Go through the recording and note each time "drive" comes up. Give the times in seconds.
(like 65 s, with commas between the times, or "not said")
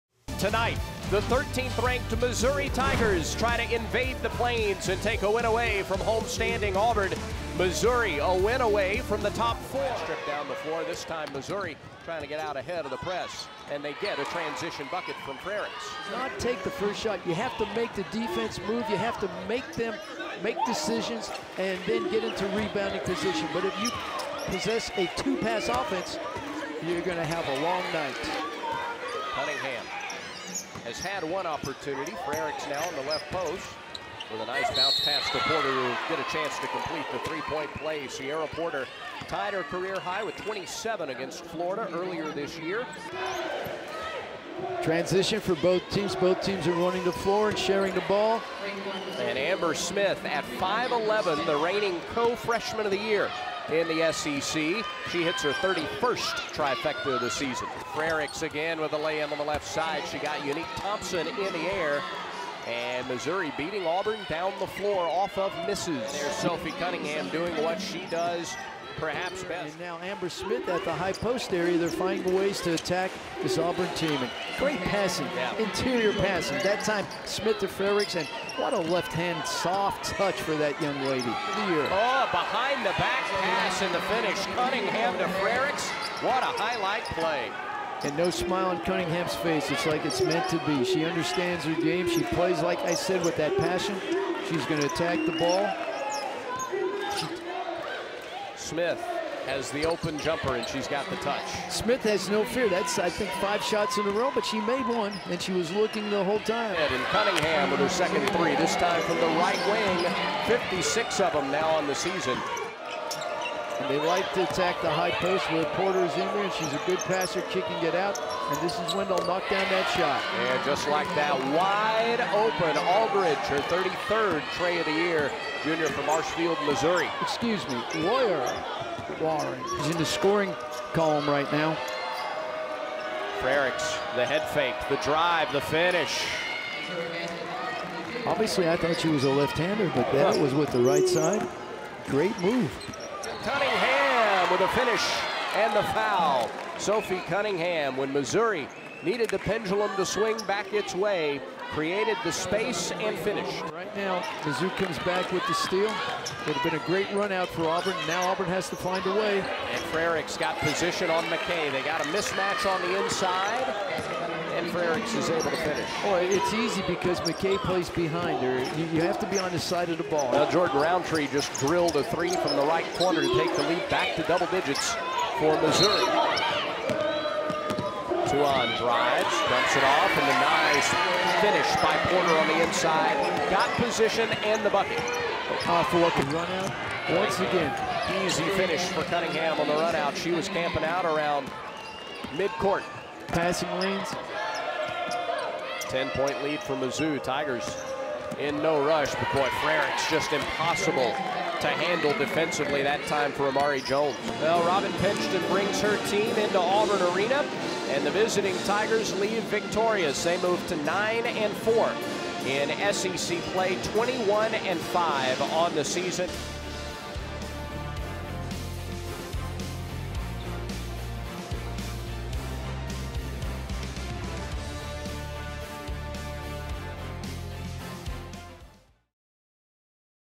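135 s, 178 s.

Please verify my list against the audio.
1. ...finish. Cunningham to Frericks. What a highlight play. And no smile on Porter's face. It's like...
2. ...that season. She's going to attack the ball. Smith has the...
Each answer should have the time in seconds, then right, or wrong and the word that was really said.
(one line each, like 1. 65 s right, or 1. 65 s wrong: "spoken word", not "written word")
1. 84 s wrong: "Cunningham", not "Porter"
2. 93 s wrong: "passion", not "season".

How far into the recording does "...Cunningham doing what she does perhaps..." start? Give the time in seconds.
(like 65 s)
66 s.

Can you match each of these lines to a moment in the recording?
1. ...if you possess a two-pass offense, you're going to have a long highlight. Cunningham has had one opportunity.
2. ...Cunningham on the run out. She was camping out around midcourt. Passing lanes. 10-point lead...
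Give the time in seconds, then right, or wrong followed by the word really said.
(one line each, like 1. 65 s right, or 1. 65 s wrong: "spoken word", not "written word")
1. 23 s wrong: "night", not "highlight"
2. 189 s right.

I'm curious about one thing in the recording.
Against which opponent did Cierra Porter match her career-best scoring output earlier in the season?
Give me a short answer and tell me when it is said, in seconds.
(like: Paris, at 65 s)
Florida, at 41 s.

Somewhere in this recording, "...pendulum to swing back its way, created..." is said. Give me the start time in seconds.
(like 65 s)
149 s.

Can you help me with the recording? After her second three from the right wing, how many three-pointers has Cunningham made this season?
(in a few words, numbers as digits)
56.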